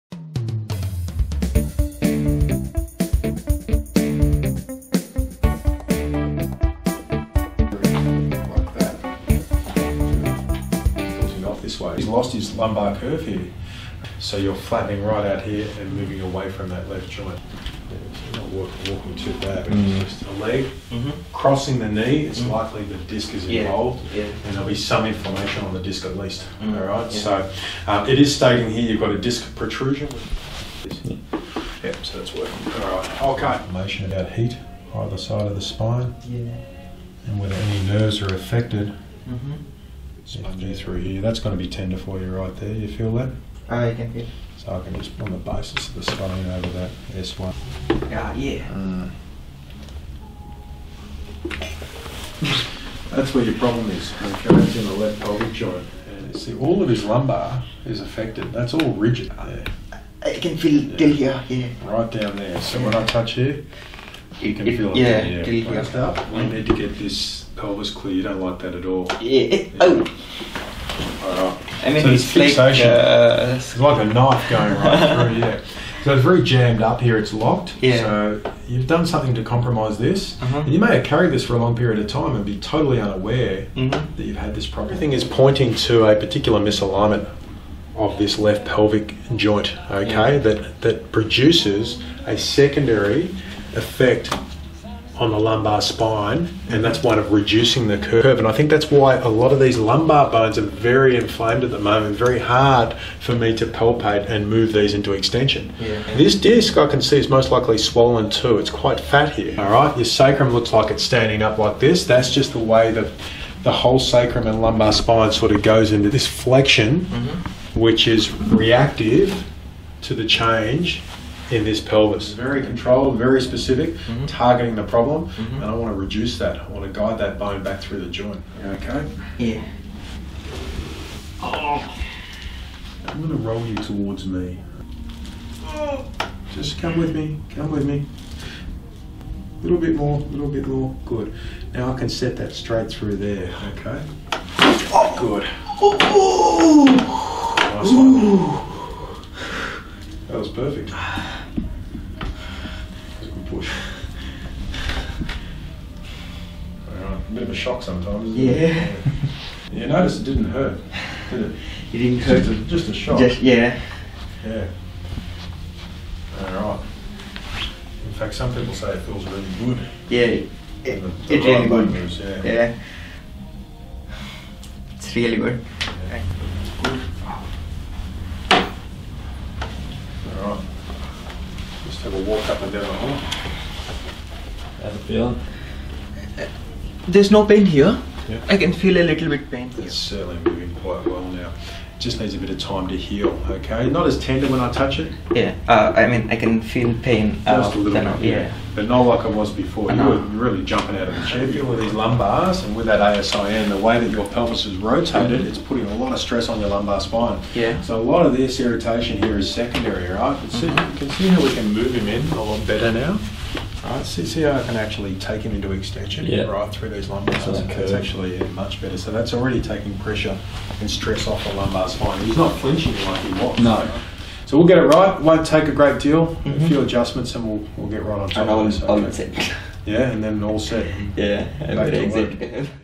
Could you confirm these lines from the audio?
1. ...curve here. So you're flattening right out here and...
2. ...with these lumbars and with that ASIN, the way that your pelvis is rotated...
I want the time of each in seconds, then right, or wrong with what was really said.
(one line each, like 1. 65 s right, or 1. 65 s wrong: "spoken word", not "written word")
1. 12 s right
2. 201 s right.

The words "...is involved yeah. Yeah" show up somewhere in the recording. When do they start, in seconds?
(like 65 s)
23 s.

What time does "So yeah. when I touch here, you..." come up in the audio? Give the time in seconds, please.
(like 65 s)
62 s.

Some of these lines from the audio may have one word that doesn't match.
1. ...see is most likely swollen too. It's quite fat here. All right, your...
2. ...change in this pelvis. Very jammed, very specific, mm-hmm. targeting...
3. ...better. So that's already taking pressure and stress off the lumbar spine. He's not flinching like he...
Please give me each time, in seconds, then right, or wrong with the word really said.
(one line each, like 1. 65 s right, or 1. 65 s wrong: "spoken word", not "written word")
1. 107 s right
2. 120 s wrong: "controlled", not "jammed"
3. 218 s right.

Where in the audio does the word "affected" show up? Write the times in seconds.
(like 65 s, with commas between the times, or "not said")
38 s, 58 s.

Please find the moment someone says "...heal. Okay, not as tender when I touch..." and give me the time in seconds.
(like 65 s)
192 s.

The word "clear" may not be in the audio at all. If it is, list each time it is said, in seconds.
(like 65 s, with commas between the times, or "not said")
67 s.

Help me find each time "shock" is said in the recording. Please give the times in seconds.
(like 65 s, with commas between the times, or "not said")
157 s, 162 s.